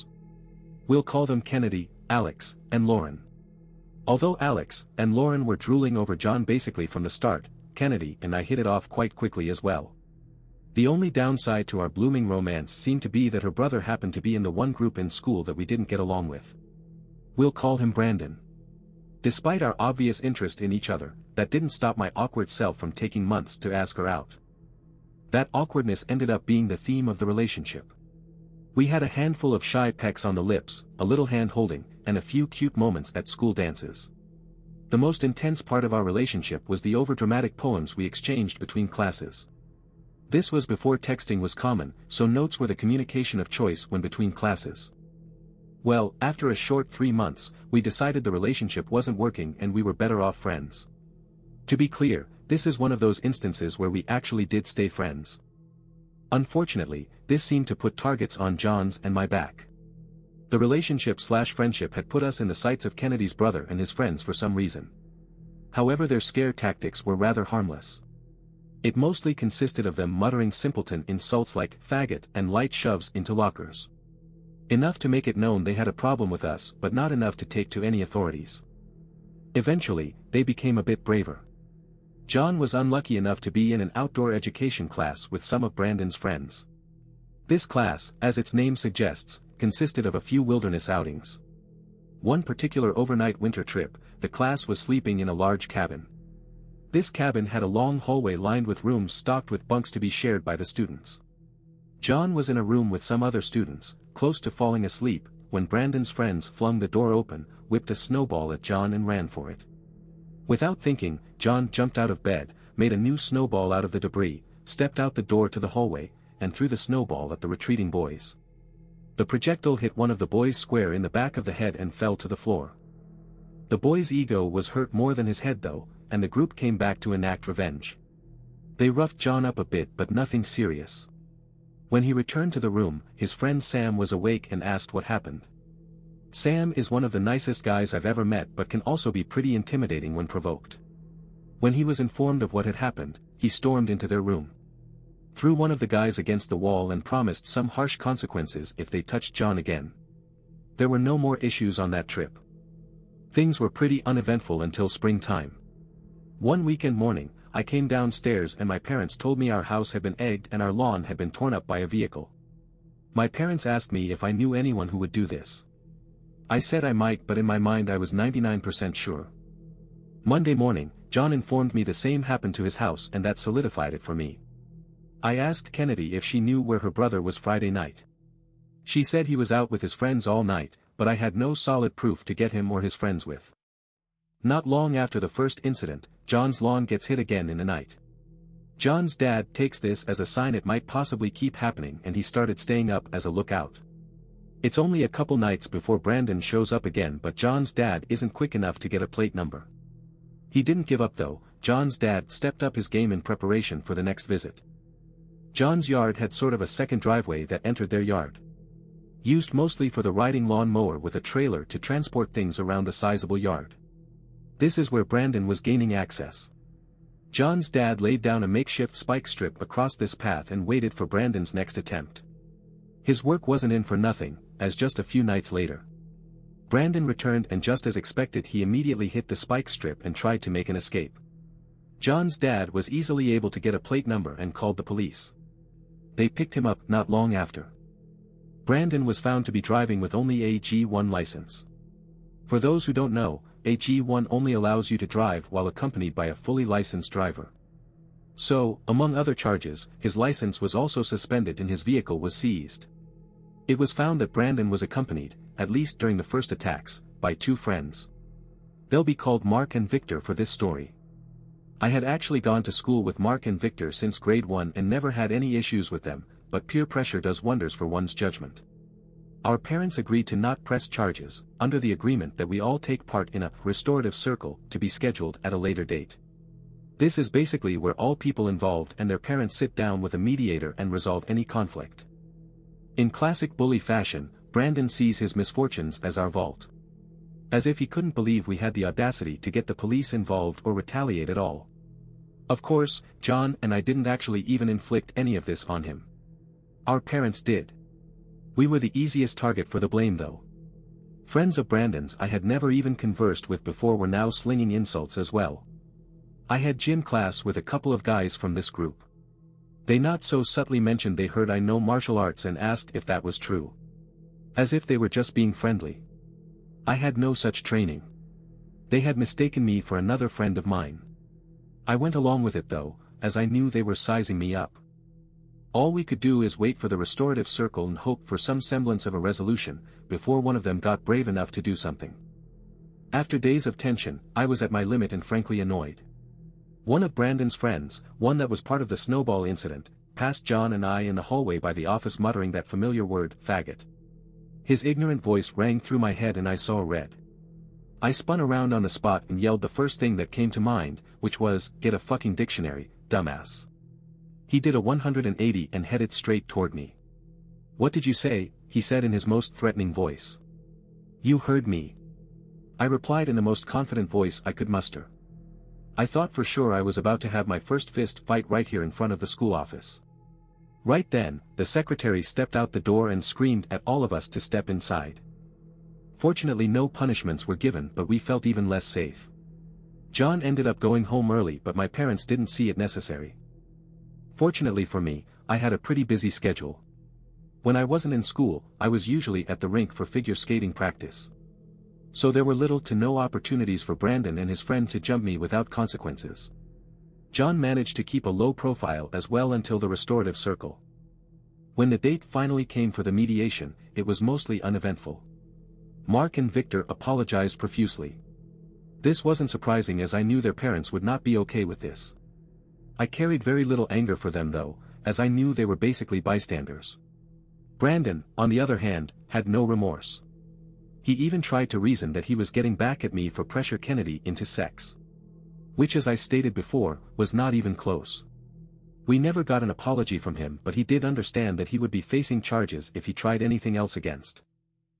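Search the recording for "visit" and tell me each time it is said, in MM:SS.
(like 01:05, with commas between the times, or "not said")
03:24.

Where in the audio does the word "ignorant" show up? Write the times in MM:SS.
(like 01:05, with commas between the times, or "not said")
05:44.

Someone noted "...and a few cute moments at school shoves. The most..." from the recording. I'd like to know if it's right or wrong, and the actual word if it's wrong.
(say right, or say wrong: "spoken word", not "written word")
wrong: "dances", not "shoves".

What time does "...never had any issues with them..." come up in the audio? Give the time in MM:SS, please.
04:24.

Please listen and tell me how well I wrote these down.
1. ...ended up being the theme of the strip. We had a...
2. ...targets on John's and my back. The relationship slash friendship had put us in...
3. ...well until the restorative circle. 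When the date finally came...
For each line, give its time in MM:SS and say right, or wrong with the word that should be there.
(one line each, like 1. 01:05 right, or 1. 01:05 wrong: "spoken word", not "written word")
1. 00:26 wrong: "relationship", not "strip"
2. 00:57 right
3. 06:39 right.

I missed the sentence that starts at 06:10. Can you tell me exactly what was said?
Right then, the secretary stepped out the door and screamed at all of us to step inside.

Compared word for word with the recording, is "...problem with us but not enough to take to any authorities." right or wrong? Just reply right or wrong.
right.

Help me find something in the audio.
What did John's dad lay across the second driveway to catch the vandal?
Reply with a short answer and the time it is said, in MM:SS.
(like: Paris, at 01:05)
A makeshift spike strip, at 03:38.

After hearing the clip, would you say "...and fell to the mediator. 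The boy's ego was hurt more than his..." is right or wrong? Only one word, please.
wrong.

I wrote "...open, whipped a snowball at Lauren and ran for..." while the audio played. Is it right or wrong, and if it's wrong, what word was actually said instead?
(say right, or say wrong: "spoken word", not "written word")
wrong: "John", not "Lauren".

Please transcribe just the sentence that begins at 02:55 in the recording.
I asked Kennedy if she knew where her brother was Friday night.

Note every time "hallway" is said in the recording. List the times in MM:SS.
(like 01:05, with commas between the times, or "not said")
01:37, 01:55, 05:41.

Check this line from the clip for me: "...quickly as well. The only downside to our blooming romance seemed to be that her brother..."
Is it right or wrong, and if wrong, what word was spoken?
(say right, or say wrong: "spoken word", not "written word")
right.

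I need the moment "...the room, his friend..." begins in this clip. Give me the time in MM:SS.
02:12.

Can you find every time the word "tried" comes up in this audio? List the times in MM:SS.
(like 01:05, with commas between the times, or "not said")
03:50, 07:01, 07:13.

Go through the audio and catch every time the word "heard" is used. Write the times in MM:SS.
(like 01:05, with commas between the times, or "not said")
05:11, 06:01.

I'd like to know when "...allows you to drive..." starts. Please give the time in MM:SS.
04:04.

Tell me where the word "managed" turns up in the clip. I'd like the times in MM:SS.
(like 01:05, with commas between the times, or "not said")
06:37.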